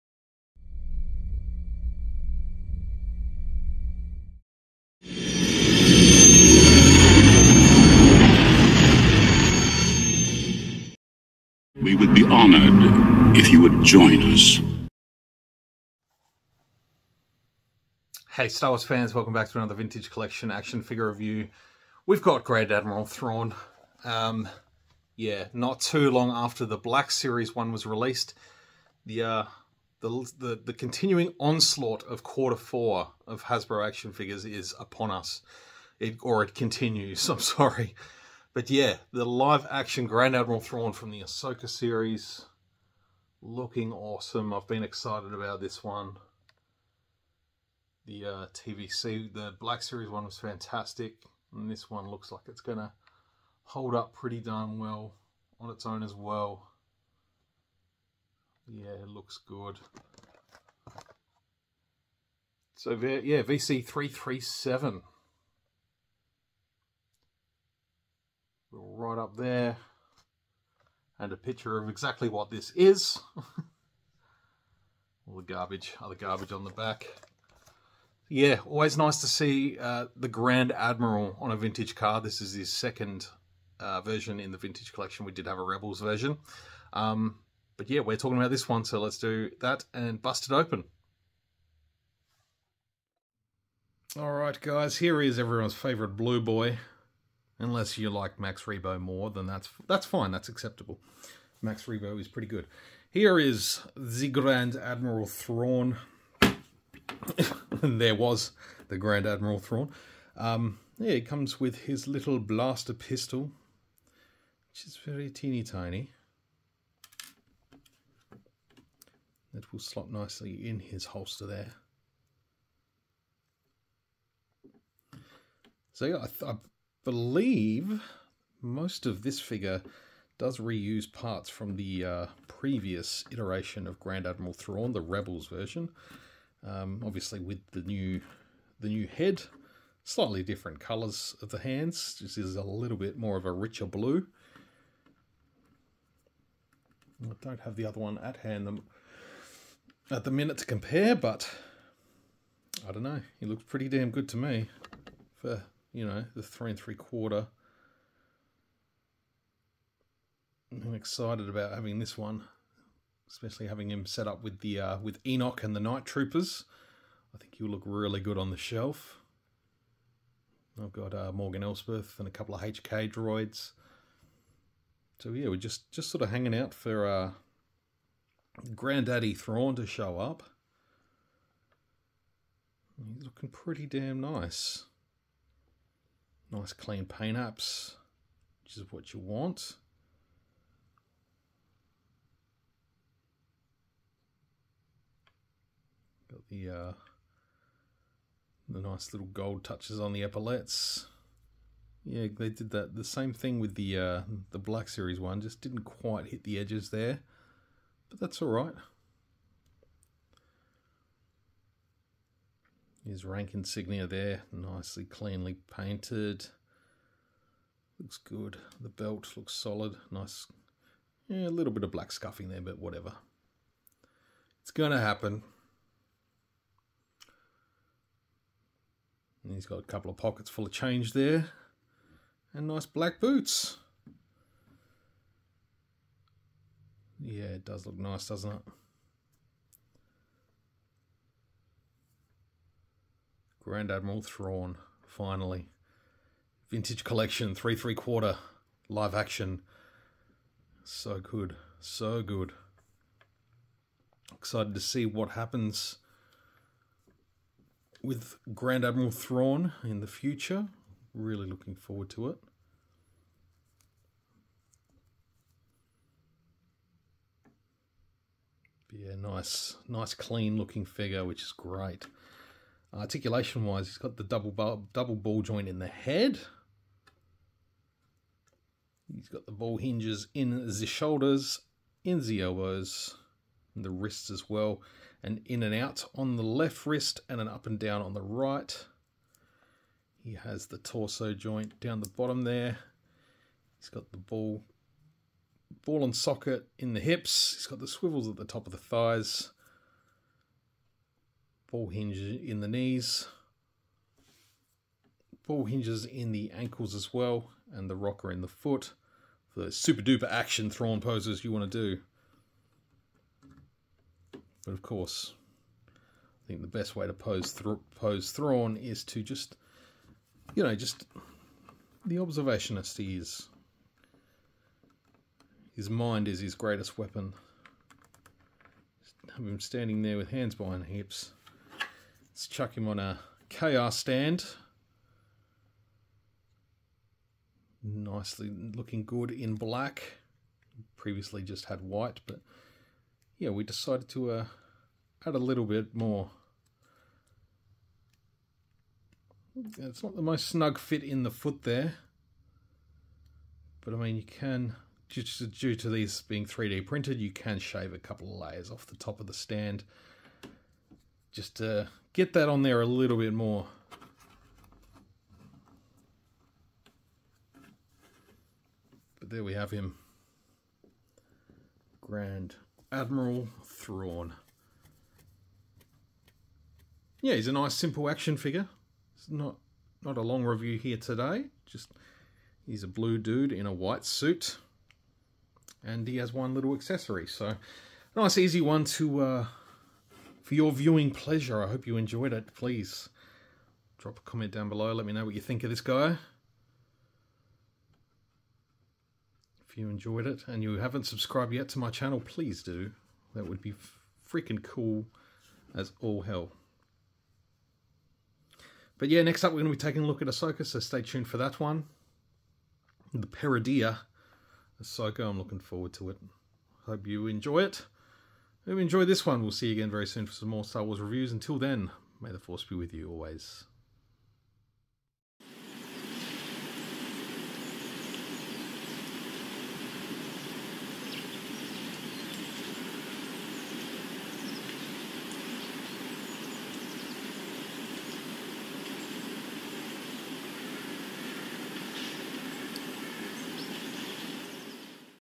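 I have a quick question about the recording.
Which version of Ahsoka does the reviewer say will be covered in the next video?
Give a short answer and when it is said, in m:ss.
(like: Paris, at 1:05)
Peridea Ahsoka, at 6:53.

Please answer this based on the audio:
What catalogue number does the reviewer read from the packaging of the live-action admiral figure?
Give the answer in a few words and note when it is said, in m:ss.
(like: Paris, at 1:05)
VC337, at 1:03.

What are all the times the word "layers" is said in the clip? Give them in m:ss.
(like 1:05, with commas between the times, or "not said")
5:58.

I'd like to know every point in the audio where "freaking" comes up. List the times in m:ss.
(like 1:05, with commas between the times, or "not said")
6:44.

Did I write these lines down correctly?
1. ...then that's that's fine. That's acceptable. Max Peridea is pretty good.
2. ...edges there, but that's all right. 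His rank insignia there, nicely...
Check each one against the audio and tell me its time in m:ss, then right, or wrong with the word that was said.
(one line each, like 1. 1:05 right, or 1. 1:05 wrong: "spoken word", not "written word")
1. 1:39 wrong: "Rebo", not "Peridea"
2. 3:26 right.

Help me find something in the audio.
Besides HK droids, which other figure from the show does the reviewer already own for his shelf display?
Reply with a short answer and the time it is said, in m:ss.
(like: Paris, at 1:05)
Morgan Elsbeth, at 2:51.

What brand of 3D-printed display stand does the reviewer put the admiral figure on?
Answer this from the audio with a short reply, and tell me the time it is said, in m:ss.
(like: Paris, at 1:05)
KR, at 5:33.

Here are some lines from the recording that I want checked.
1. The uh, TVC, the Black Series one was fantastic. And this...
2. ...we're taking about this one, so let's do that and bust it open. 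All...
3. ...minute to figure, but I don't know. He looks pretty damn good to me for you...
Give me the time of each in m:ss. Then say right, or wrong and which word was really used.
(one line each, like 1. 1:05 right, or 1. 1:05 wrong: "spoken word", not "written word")
1. 0:48 right
2. 1:28 wrong: "talking", not "taking"
3. 2:30 wrong: "compare", not "figure".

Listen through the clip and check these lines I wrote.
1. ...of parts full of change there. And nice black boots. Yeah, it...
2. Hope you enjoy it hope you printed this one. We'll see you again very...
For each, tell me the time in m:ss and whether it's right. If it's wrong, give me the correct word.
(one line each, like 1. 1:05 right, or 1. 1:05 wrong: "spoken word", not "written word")
1. 3:50 wrong: "pockets", not "parts"
2. 6:56 wrong: "enjoyed", not "printed".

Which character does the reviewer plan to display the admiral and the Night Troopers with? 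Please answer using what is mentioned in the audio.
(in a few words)
Enoch.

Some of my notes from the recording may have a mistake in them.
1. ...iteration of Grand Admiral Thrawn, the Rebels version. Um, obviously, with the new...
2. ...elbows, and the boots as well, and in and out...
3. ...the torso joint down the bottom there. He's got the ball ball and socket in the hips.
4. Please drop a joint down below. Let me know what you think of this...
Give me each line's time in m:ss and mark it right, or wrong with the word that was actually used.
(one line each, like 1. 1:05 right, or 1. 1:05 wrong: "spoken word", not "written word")
1. 2:13 right
2. 4:42 wrong: "wrists", not "boots"
3. 4:50 right
4. 6:32 wrong: "comment", not "joint".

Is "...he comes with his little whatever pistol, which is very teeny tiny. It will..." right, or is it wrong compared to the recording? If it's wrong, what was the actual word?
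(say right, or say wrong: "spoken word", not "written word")
wrong: "blaster", not "whatever".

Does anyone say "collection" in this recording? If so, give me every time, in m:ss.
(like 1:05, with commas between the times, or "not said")
0:20, 1:24, 4:07.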